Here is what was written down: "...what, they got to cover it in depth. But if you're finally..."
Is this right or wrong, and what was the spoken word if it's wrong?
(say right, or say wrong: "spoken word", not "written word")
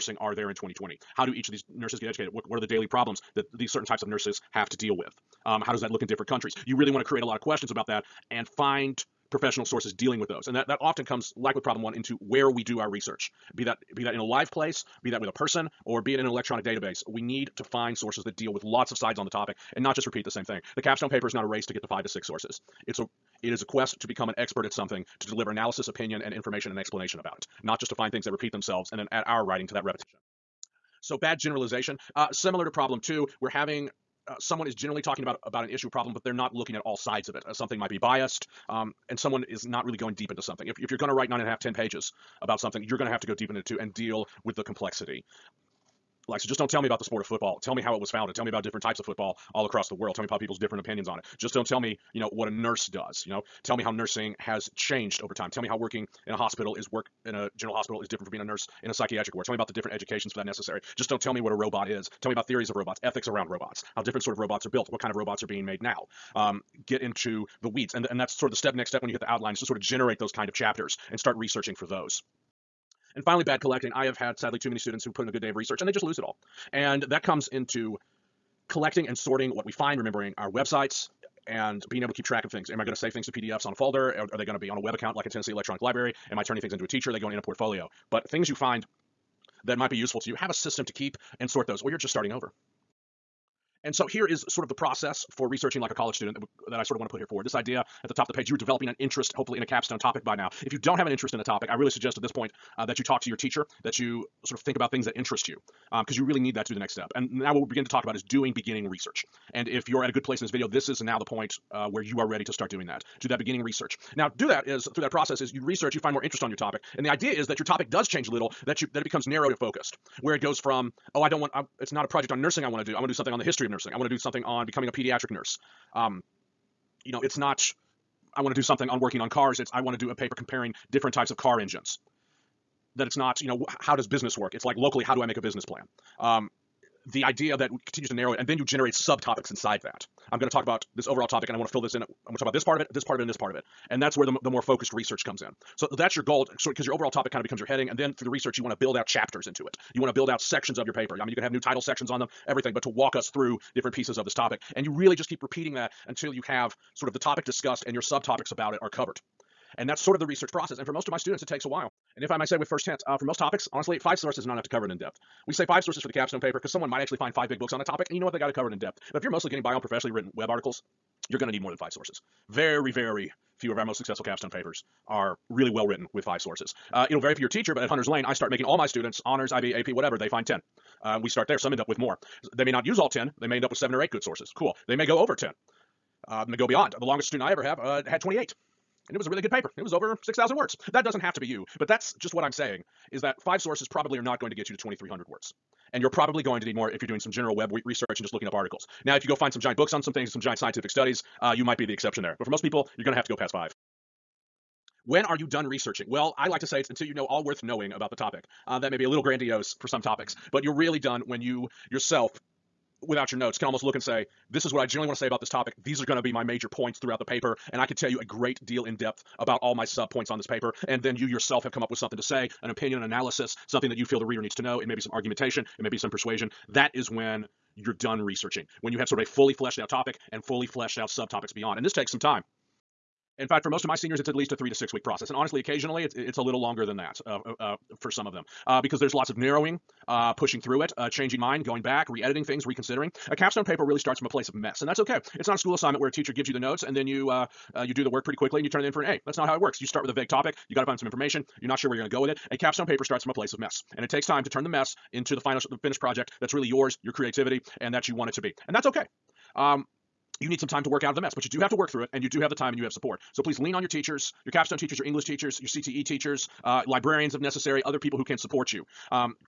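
wrong: "mostly", not "finally".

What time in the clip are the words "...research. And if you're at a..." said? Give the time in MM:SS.
01:48.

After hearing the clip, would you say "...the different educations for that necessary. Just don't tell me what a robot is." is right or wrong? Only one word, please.
right.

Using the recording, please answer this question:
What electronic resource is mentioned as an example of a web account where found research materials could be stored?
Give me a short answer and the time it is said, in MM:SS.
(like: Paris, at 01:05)
Tennessee Electronic Library, at 01:25.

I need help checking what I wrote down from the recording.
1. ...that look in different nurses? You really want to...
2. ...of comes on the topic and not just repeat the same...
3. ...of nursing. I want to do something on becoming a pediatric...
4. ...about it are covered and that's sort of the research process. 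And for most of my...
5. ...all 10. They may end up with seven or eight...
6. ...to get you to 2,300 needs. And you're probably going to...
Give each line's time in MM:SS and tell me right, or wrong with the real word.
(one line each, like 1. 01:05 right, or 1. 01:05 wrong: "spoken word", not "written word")
1. 00:05 wrong: "countries", not "nurses"
2. 00:18 wrong: "sides", not "comes"
3. 02:03 right
4. 02:38 right
5. 03:02 right
6. 03:14 wrong: "words", not "needs".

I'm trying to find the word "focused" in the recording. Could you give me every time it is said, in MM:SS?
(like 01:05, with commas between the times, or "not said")
01:59, 02:24.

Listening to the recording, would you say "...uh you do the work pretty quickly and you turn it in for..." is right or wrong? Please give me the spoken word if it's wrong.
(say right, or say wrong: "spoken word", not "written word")
right.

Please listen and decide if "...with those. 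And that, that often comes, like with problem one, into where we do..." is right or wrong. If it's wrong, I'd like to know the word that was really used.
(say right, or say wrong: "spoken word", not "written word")
right.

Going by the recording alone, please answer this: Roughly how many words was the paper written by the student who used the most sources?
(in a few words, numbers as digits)
6,000.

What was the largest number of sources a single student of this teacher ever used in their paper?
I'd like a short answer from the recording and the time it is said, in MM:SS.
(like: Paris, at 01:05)
28, at 03:08.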